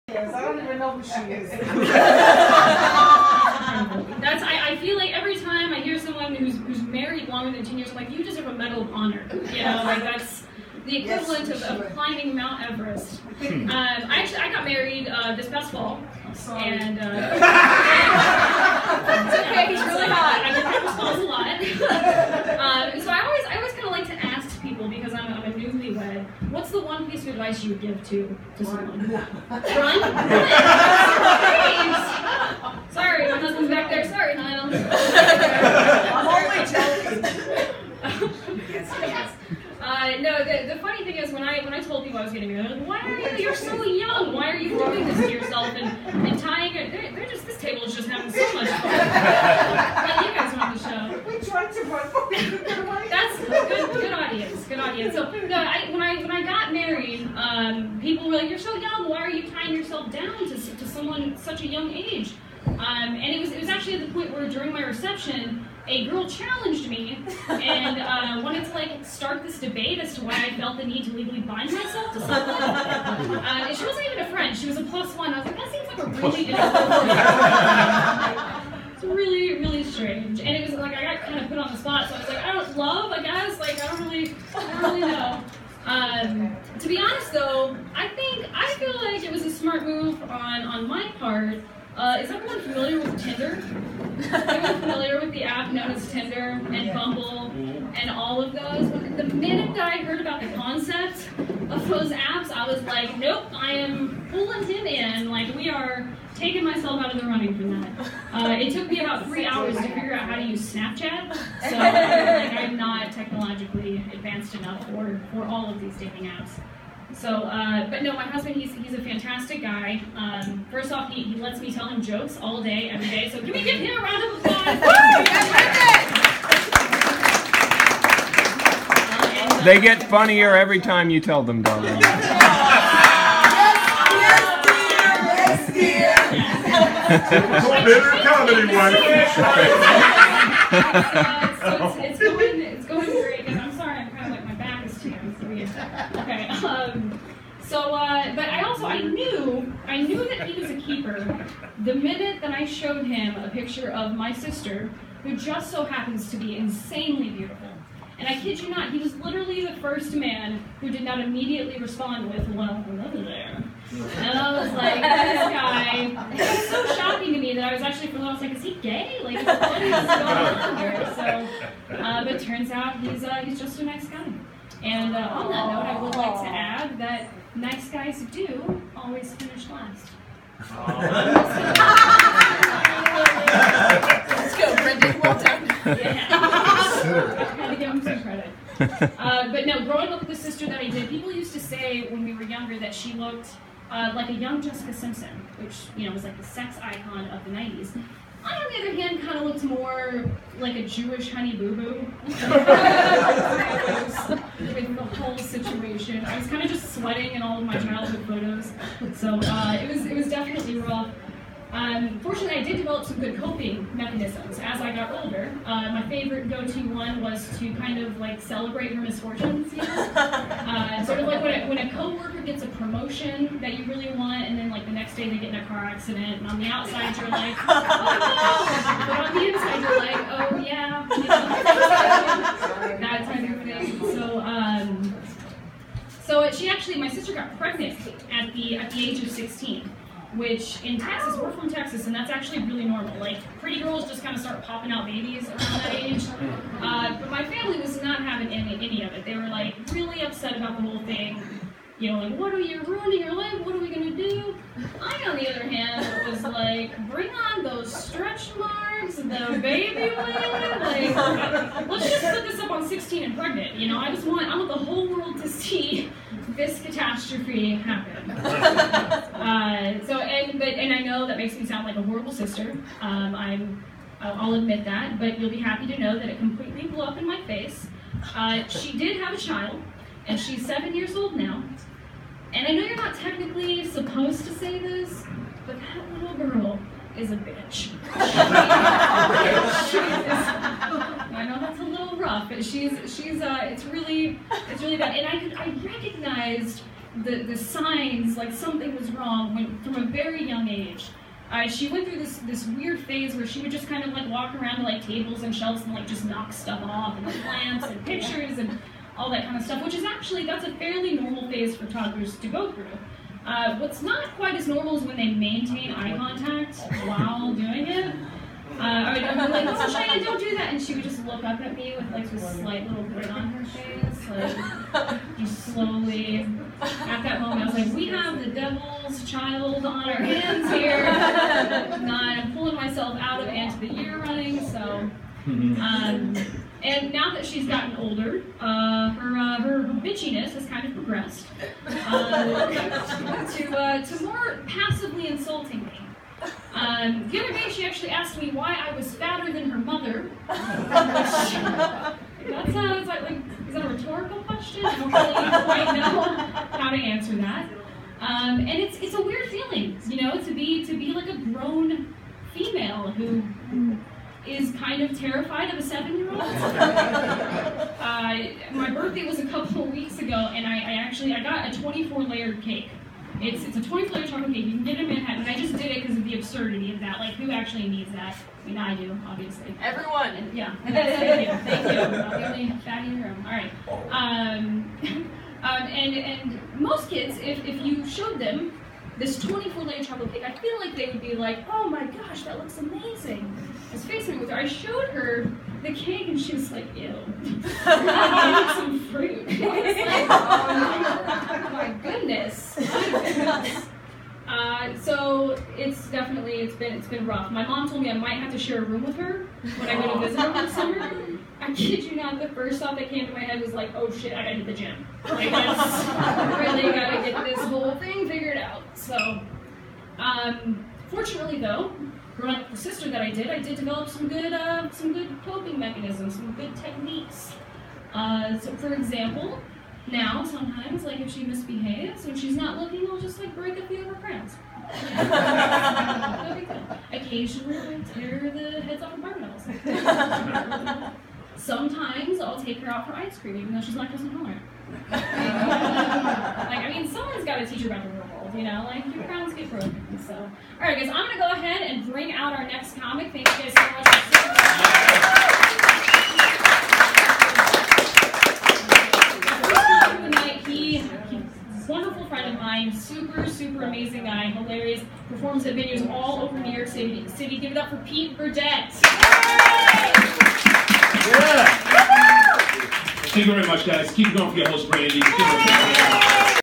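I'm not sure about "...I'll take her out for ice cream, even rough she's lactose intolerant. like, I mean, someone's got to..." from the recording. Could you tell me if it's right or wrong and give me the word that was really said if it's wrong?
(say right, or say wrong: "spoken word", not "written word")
wrong: "though", not "rough".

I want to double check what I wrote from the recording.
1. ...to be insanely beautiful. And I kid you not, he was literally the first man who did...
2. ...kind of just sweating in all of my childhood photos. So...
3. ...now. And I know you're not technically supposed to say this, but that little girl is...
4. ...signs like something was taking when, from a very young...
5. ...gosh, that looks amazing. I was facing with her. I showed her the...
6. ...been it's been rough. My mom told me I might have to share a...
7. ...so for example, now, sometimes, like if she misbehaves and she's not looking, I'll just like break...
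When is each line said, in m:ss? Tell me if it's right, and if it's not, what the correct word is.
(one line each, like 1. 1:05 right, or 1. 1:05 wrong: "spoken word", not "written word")
1. 2:36 right
2. 3:26 right
3. 4:41 right
4. 4:57 wrong: "wrong", not "taking"
5. 6:32 right
6. 6:46 right
7. 7:08 right.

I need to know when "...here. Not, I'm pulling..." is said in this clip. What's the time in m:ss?
5:30.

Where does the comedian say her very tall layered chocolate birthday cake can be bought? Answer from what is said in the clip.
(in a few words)
Manhattan.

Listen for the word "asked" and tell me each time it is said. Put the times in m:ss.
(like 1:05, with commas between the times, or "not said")
5:48.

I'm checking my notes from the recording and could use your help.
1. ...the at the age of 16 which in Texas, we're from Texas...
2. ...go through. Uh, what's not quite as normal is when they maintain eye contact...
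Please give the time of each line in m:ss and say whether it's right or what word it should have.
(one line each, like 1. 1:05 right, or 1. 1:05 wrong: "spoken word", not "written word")
1. 3:58 right
2. 5:12 right.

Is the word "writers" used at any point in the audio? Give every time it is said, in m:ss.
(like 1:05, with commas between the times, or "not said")
not said.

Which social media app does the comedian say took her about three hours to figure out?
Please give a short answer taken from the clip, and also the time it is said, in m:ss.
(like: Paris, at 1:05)
Snapchat, at 1:50.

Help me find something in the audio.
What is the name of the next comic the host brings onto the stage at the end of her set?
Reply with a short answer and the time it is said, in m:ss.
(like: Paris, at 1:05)
Pete Burdett, at 7:47.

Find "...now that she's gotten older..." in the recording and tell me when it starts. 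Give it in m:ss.
5:37.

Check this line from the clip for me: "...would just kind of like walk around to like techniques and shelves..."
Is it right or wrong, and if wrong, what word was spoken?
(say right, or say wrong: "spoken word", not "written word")
wrong: "tables", not "techniques".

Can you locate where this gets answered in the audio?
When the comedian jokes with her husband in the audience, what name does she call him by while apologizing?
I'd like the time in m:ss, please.
0:34.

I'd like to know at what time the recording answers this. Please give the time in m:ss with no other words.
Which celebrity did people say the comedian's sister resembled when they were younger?
3:14.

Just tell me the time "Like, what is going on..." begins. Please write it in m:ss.
2:49.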